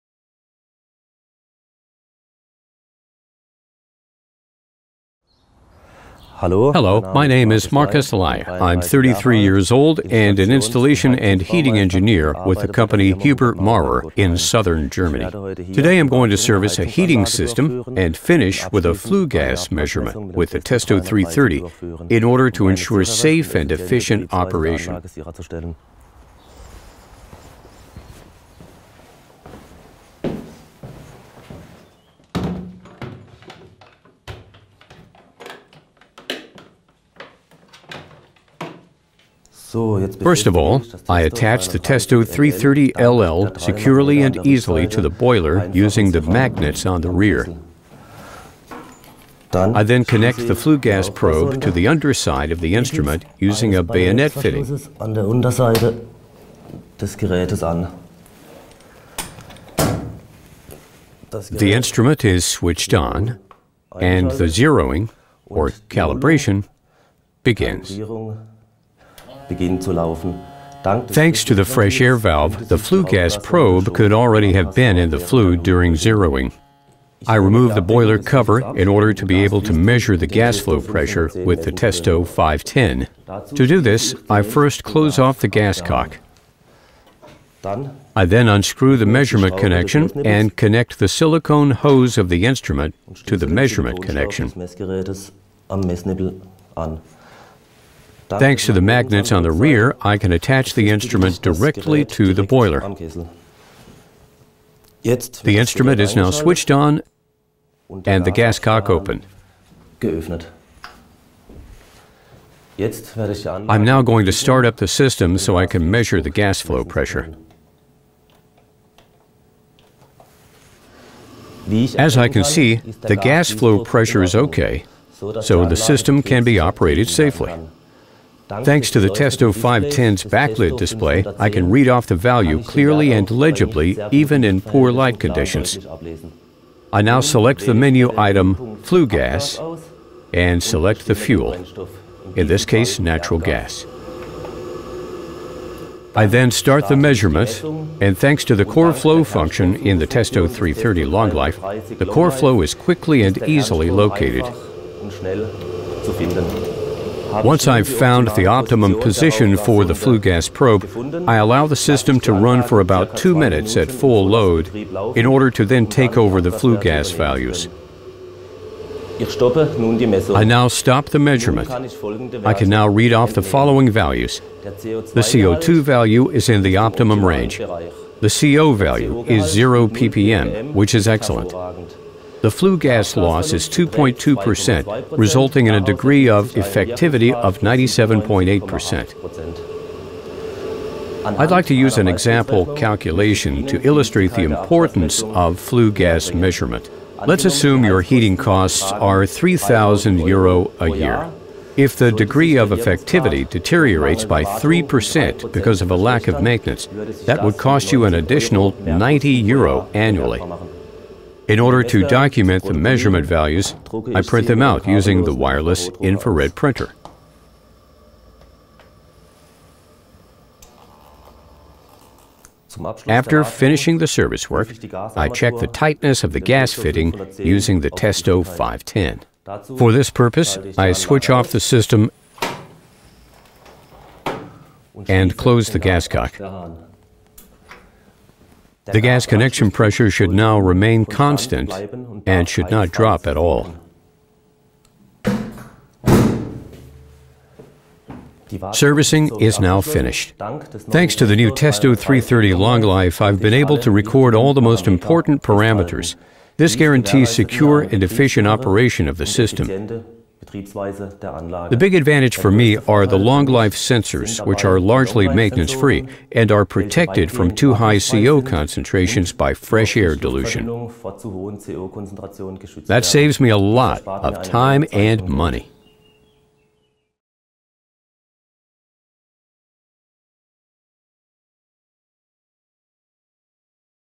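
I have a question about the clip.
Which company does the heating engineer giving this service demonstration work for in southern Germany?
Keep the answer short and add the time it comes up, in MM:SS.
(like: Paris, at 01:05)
Hubert Maurer, at 00:13.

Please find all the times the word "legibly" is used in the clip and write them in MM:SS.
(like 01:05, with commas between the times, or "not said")
02:13.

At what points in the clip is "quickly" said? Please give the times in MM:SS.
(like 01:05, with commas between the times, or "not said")
02:32.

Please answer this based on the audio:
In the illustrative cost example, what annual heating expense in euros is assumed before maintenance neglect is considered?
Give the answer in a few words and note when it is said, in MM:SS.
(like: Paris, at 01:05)
3,000 euro, at 03:19.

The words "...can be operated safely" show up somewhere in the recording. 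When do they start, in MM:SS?
02:06.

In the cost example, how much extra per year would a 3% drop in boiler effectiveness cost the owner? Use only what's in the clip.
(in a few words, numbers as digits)
90 euro.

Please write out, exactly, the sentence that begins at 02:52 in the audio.
I can now read off the following values.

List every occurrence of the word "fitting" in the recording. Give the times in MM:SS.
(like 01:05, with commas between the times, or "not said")
00:54, 03:46.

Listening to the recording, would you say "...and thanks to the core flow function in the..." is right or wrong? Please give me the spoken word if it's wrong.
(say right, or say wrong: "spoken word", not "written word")
right.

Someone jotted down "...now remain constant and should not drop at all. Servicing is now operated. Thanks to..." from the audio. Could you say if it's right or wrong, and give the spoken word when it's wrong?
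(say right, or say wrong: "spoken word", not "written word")
wrong: "finished", not "operated".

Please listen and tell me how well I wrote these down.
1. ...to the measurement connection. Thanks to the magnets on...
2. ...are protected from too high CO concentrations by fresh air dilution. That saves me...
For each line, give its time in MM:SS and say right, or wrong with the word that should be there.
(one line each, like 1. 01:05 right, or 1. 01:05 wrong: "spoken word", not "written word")
1. 01:33 right
2. 04:26 right.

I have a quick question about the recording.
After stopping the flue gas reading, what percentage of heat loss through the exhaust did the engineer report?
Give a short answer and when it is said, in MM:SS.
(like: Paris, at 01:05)
2.2%, at 03:03.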